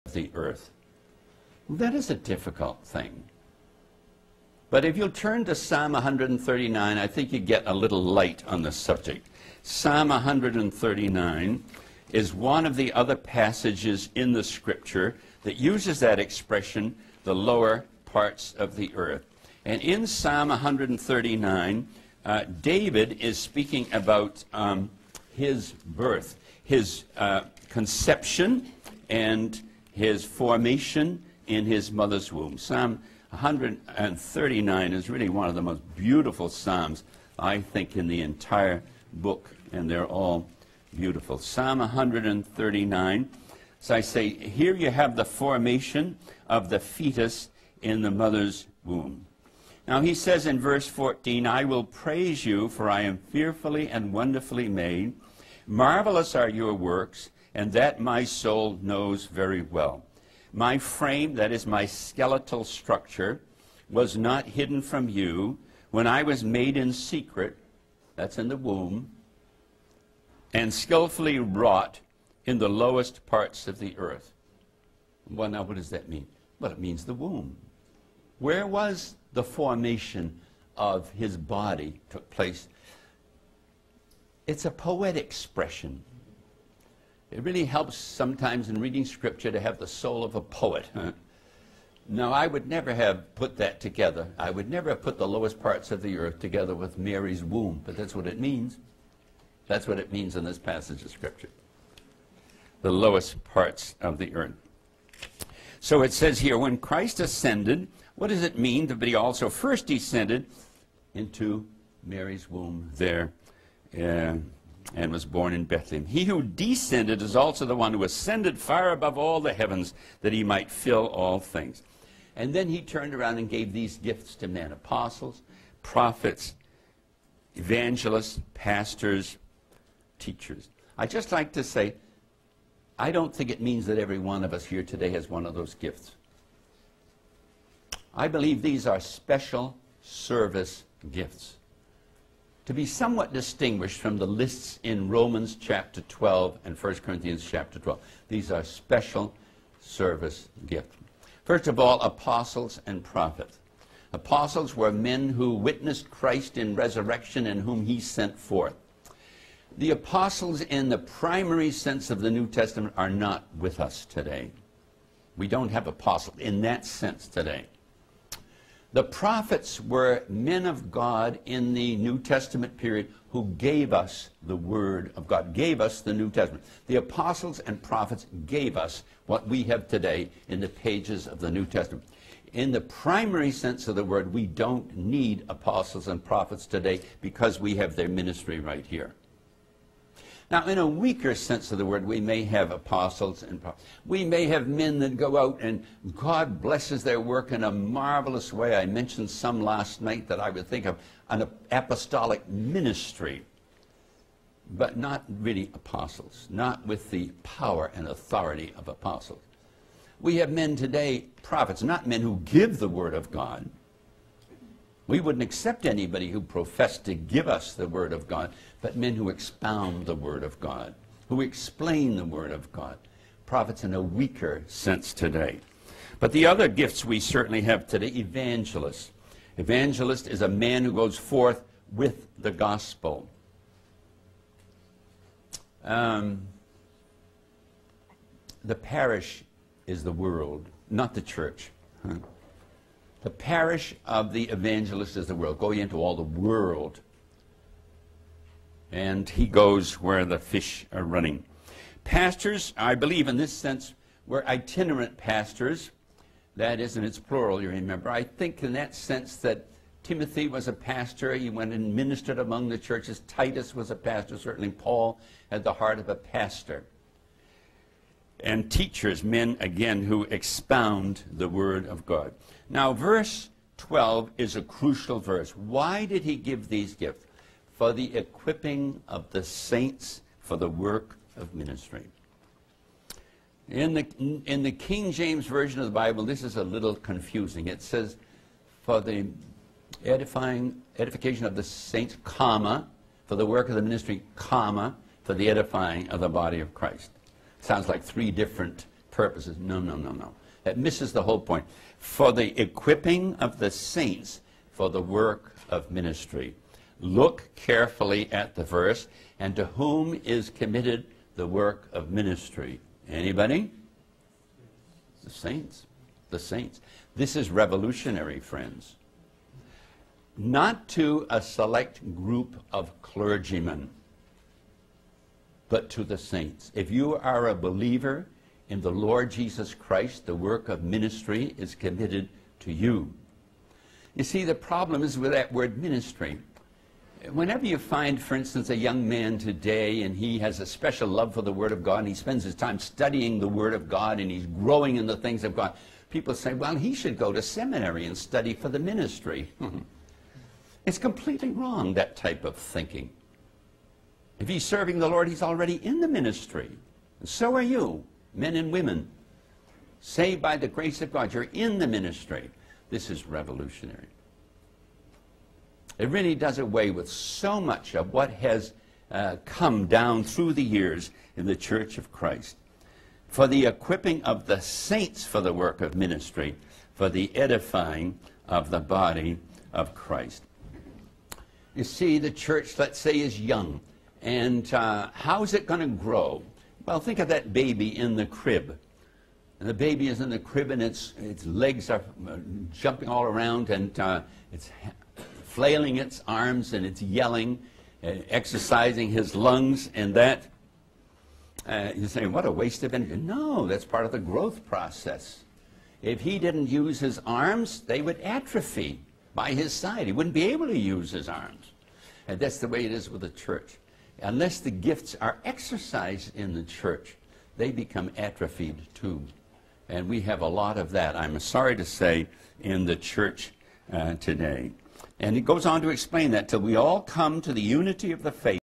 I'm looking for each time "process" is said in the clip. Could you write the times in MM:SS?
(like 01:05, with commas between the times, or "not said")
06:44.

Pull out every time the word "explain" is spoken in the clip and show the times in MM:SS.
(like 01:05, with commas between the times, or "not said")
03:41, 07:05.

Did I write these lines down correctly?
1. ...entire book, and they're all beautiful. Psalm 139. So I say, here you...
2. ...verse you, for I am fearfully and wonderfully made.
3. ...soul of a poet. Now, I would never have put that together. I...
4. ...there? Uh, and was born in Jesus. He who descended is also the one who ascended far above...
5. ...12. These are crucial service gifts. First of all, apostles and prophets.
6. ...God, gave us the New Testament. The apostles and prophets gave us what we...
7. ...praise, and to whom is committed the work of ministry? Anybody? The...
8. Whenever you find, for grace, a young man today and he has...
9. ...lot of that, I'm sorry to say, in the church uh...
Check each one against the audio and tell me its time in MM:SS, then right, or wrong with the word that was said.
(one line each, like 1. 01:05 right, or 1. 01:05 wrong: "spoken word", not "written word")
1. 00:38 right
2. 00:51 wrong: "praise", not "verse"
3. 01:29 right
4. 01:52 wrong: "Bethlehem", not "Jesus"
5. 02:27 wrong: "special", not "crucial"
6. 02:55 right
7. 05:08 wrong: "verse", not "praise"
8. 05:37 wrong: "instance", not "grace"
9. 07:00 right.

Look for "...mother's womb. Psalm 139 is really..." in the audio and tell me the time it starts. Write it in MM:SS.
00:31.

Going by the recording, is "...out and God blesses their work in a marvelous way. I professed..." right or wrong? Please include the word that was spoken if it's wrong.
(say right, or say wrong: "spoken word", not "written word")
wrong: "mentioned", not "professed".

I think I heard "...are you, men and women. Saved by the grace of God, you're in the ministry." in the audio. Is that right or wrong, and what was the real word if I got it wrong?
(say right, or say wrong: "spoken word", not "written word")
right.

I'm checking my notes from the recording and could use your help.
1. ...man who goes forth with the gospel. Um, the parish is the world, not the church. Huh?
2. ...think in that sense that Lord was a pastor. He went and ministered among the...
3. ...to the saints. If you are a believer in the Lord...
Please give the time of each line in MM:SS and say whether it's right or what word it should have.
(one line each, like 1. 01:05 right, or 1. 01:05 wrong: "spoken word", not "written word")
1. 03:50 right
2. 04:18 wrong: "Timothy", not "Lord"
3. 05:25 right.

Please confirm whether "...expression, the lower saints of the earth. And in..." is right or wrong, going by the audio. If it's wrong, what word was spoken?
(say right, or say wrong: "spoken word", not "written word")
wrong: "parts", not "saints".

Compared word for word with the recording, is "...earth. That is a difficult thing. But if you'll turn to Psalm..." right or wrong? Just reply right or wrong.
right.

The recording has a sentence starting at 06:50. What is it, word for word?
He wouldn't be able to use his arms.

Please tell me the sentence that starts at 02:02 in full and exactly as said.
And then he turned around and gave these gifts to men apostles, prophets, evangelists, pastors, teachers.